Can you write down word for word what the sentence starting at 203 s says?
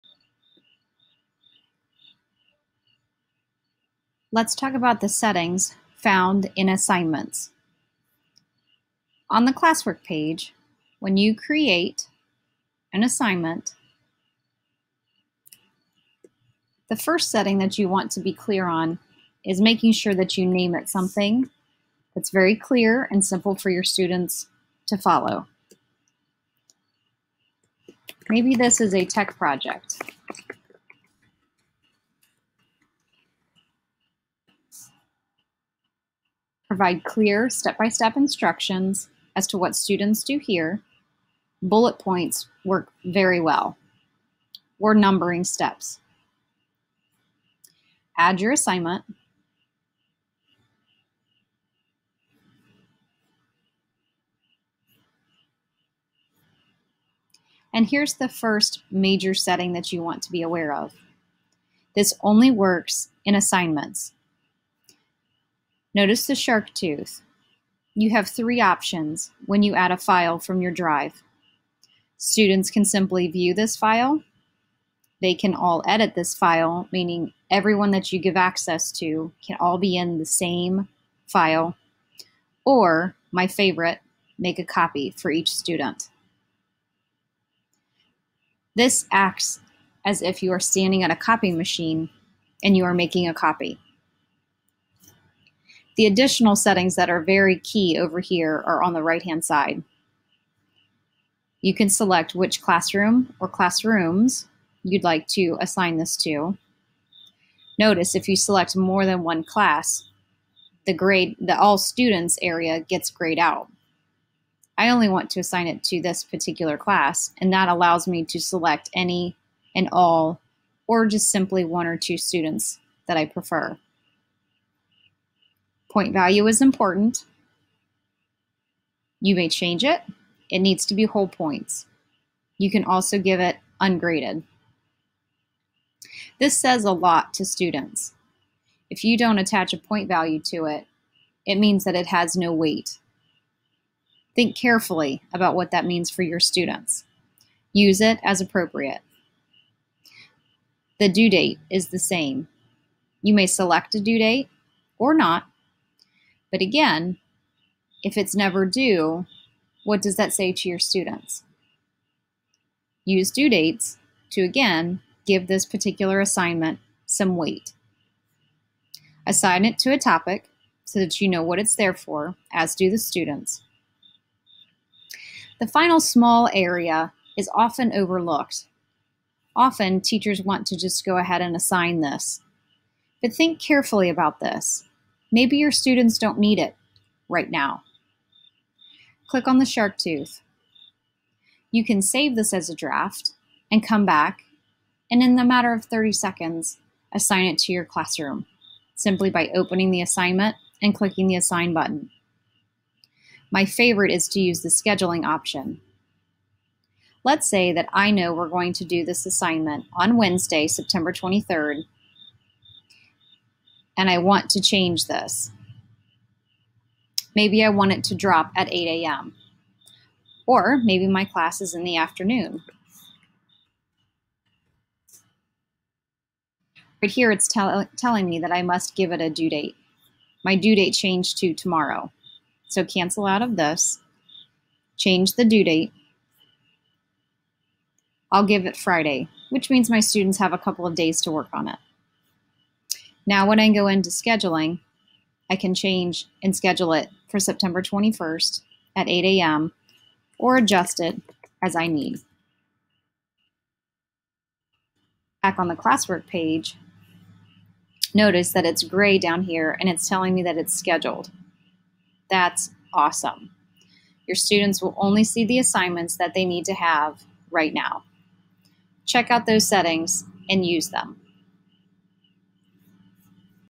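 My favorite is to use the scheduling option.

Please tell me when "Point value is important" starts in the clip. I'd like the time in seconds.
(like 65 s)
125 s.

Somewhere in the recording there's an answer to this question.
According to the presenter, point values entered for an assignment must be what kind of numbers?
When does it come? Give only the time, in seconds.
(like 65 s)
131 s.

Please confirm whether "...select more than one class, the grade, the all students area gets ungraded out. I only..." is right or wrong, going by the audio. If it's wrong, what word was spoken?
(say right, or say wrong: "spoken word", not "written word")
wrong: "grayed", not "ungraded".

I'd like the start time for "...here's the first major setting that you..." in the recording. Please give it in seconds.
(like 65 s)
57 s.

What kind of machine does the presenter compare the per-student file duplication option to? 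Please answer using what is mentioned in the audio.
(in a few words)
copying machine.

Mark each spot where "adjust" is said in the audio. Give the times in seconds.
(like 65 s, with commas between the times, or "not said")
250 s.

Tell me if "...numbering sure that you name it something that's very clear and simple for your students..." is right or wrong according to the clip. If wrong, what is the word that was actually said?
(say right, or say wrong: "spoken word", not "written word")
wrong: "making", not "numbering".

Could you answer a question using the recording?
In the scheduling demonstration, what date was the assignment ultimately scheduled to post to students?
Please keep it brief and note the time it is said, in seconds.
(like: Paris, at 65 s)
September 21st, at 247 s.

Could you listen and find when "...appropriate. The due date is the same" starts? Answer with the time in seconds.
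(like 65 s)
148 s.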